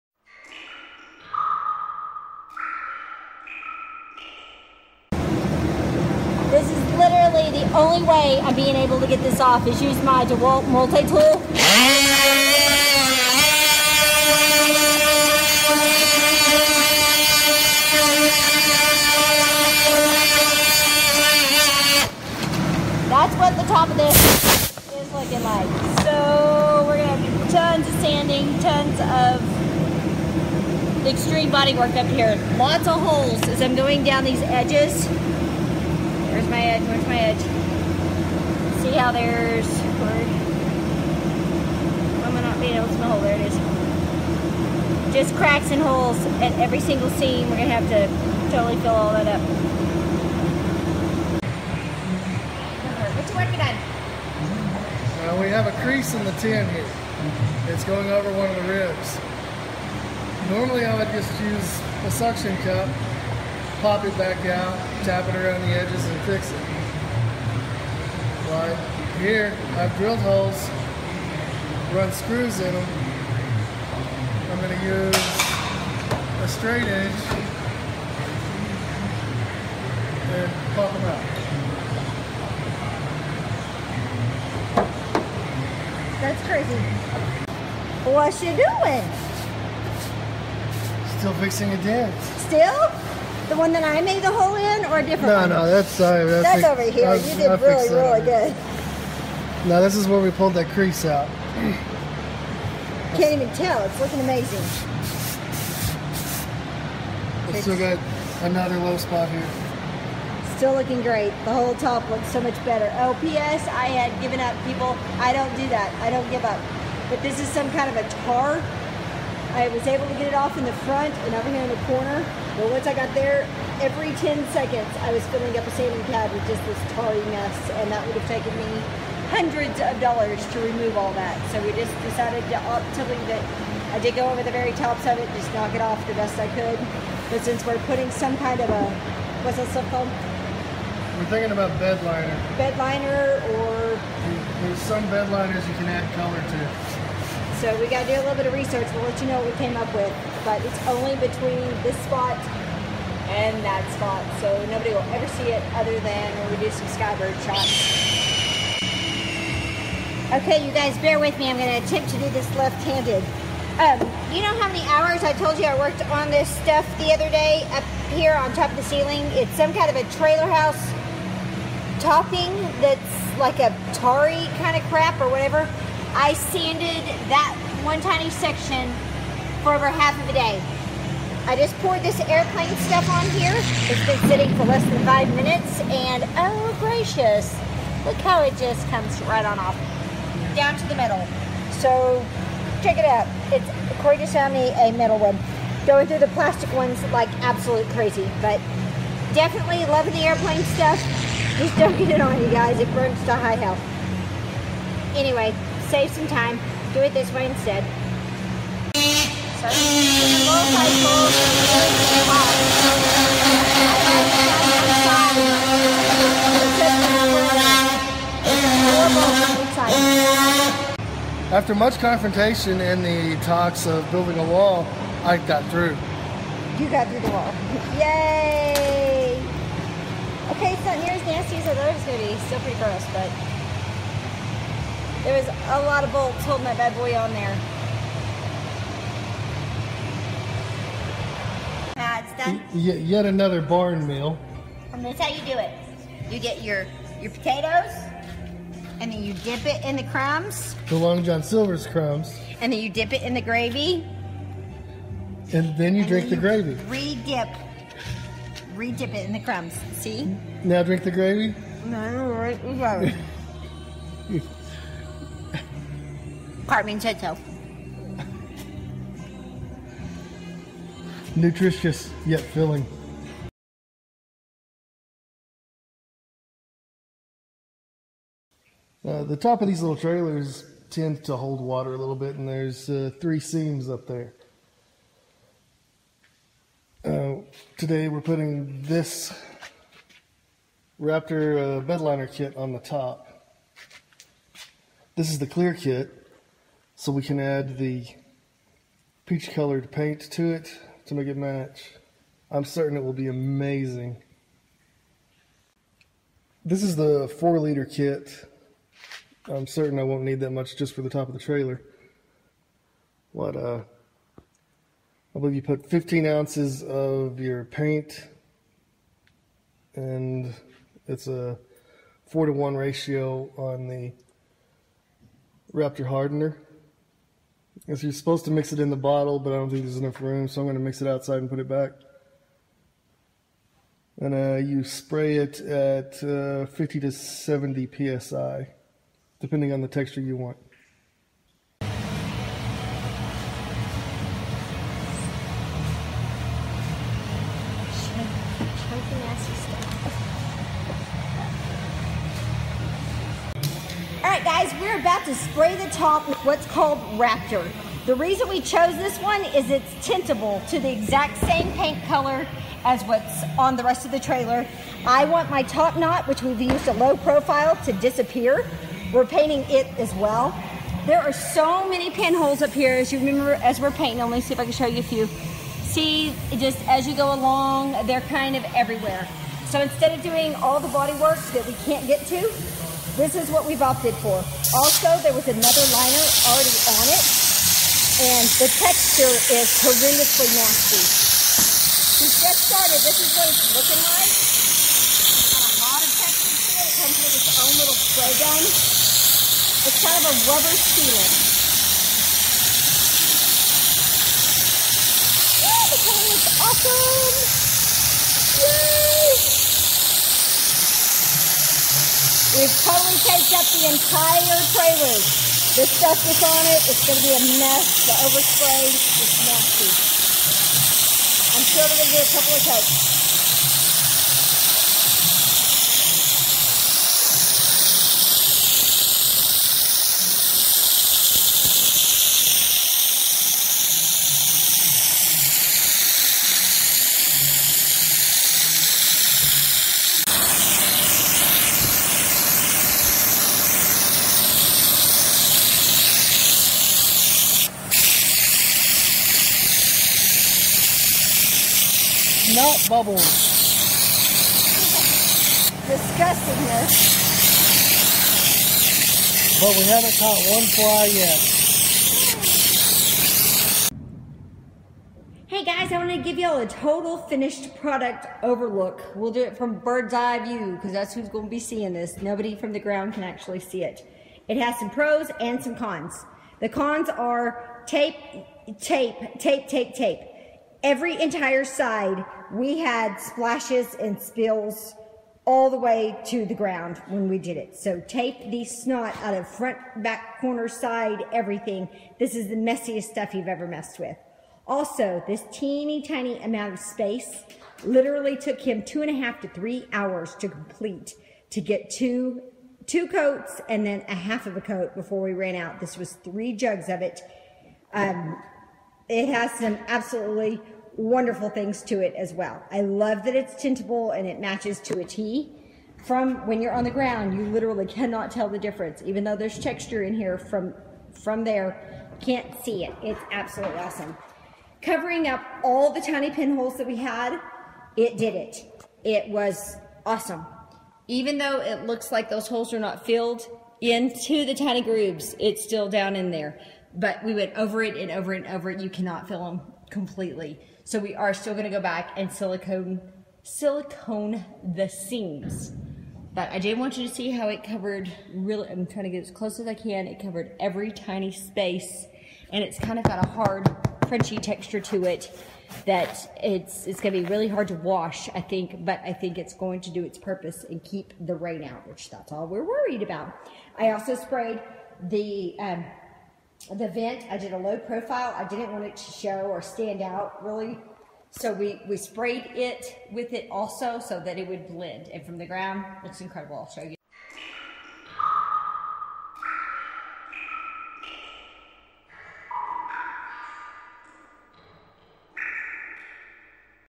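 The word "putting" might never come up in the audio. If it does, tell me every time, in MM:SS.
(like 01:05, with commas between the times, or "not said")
02:17, 04:48.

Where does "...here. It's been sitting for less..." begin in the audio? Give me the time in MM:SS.
03:03.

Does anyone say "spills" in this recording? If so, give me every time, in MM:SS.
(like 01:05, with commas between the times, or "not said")
08:04.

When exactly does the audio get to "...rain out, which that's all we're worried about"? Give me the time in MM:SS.
09:21.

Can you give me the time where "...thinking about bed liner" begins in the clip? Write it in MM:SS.
02:21.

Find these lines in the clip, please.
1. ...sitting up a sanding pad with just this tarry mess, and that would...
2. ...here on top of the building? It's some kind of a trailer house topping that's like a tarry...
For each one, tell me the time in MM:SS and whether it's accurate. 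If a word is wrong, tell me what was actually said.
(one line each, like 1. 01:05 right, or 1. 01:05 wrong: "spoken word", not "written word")
1. 02:05 wrong: "filling", not "sitting"
2. 02:48 wrong: "ceiling", not "building".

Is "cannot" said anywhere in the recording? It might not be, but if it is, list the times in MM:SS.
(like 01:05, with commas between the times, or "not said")
08:37, 08:58.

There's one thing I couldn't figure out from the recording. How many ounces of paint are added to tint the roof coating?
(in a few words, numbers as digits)
15.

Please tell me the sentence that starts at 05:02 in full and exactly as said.
I'm certain it will be amazing.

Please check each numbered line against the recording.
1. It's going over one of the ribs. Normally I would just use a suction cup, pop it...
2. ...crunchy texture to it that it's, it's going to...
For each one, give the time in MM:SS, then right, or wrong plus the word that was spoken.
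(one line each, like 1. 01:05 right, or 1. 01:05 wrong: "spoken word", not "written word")
1. 00:57 right
2. 09:14 right.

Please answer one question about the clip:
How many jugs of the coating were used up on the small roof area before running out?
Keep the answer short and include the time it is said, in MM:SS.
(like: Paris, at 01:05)
3, at 08:26.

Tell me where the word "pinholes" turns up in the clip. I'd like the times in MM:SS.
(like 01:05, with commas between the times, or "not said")
06:12, 08:46.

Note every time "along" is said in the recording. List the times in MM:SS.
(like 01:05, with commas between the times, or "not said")
06:17.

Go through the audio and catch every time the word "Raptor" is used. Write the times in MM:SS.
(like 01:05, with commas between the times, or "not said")
04:51, 05:25, 05:57.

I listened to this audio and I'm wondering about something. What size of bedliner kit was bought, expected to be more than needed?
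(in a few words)
4 liter.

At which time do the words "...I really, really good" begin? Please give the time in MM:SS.
01:37.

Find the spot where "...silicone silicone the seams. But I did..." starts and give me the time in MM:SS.
09:02.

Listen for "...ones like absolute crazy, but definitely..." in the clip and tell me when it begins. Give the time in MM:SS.
03:16.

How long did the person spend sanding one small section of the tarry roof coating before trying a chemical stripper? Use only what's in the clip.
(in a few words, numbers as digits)
over half of a day.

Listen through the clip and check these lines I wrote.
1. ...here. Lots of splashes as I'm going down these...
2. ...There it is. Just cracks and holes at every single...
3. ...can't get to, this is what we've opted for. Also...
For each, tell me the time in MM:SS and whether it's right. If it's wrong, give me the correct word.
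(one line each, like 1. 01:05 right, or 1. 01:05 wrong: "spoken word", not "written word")
1. 00:32 wrong: "holes", not "splashes"
2. 00:43 right
3. 06:21 right.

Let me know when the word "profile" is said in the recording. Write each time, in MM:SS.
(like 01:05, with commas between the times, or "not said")
06:07, 09:27.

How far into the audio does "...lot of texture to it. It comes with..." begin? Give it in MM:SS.
06:35.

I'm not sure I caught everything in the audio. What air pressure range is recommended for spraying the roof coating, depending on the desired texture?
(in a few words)
50 to 70 psi.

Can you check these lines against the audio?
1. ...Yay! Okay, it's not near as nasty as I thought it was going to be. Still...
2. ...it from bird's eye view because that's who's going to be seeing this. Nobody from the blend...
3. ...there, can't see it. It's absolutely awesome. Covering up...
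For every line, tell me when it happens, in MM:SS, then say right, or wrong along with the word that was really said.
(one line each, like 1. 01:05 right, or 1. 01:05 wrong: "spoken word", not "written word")
1. 03:47 right
2. 07:49 wrong: "ground", not "blend"
3. 08:41 right.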